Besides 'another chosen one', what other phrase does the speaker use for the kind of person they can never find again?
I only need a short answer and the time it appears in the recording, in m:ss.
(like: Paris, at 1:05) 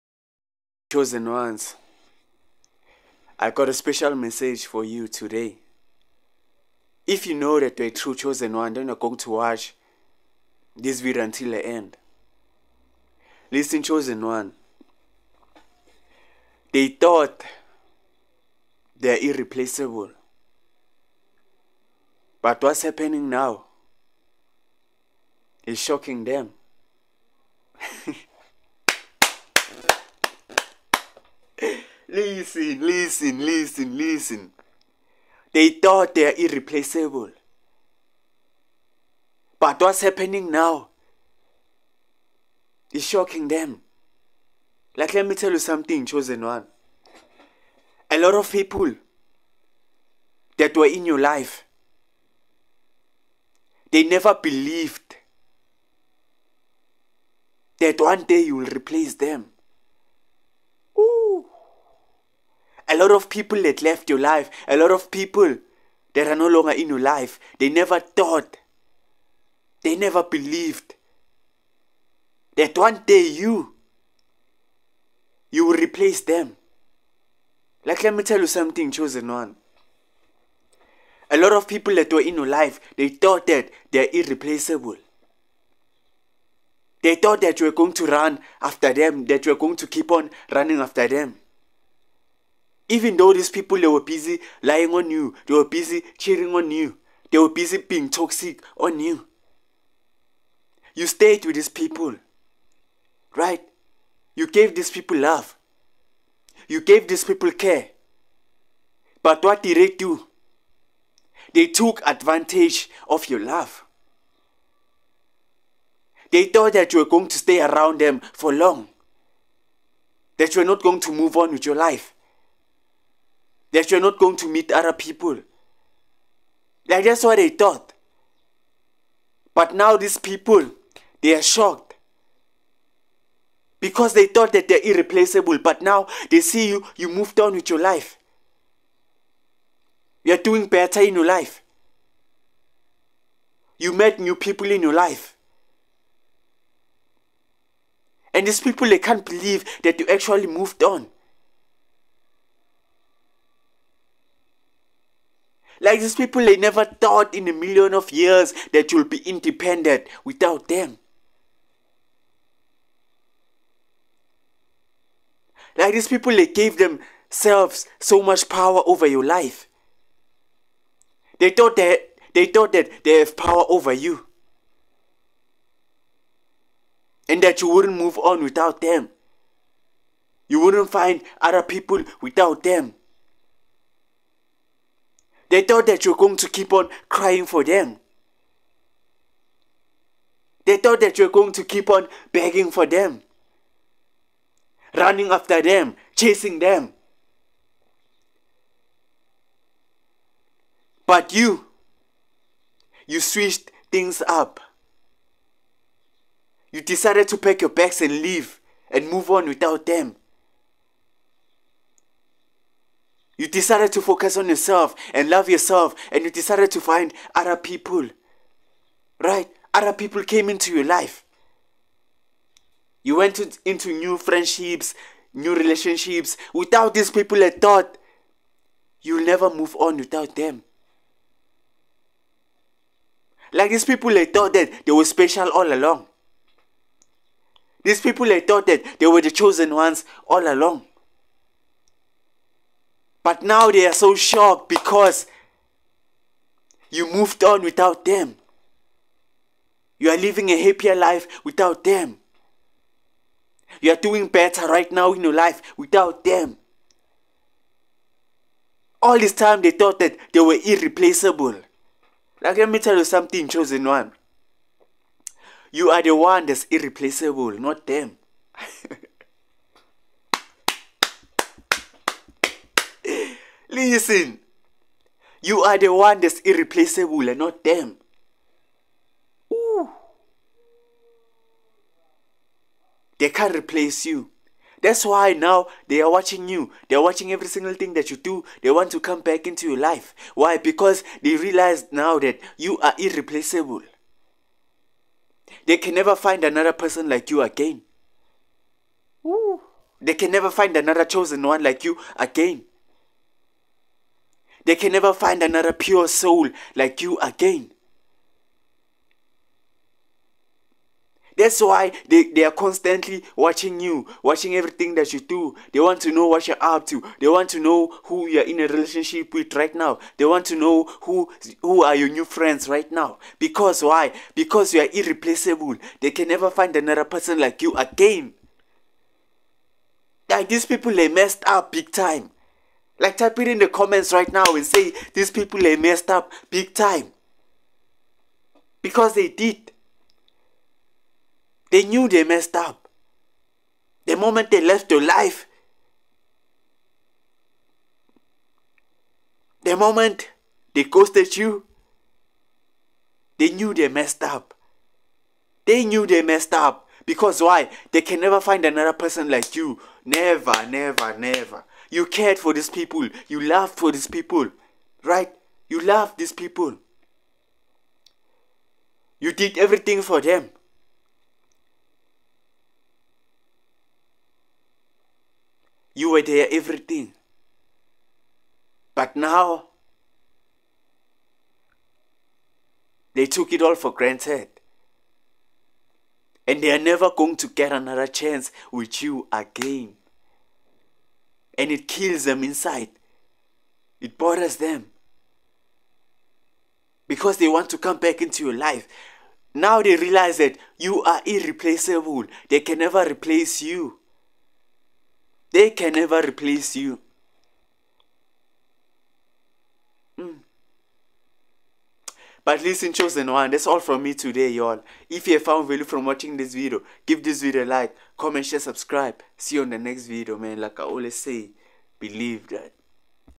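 pure soul, at 5:05.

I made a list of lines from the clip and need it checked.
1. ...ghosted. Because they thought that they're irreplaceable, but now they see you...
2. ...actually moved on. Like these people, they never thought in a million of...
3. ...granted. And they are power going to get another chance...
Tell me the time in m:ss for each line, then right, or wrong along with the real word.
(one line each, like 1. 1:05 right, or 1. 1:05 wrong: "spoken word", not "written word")
1. 2:11 wrong: "shocked", not "ghosted"
2. 2:30 right
3. 6:23 wrong: "never", not "power".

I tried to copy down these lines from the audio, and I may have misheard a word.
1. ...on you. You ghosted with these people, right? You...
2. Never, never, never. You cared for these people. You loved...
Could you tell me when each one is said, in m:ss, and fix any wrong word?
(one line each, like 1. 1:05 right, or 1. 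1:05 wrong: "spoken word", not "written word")
1. 1:38 wrong: "stayed", not "ghosted"
2. 6:00 right.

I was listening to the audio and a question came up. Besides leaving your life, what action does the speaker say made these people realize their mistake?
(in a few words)
ghosted you.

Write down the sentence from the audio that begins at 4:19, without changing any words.
All this time they thought that they were irreplaceable.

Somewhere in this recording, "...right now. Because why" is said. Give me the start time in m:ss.
5:22.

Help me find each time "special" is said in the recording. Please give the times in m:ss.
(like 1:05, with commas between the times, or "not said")
0:03, 3:55.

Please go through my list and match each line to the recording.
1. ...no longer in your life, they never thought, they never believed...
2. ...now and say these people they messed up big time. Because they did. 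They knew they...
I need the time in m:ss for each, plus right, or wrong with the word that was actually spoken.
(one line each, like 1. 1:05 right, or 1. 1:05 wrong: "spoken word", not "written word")
1. 1:06 right
2. 5:34 right.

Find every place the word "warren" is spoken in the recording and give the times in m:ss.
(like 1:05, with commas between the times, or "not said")
not said.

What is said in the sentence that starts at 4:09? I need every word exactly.
You are living a happier life without them.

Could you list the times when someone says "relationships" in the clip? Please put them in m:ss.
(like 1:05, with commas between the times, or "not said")
3:45, 5:18.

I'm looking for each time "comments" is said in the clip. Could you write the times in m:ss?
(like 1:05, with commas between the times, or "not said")
5:33, 6:58.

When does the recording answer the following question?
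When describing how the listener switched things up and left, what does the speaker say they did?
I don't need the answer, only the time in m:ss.
3:27.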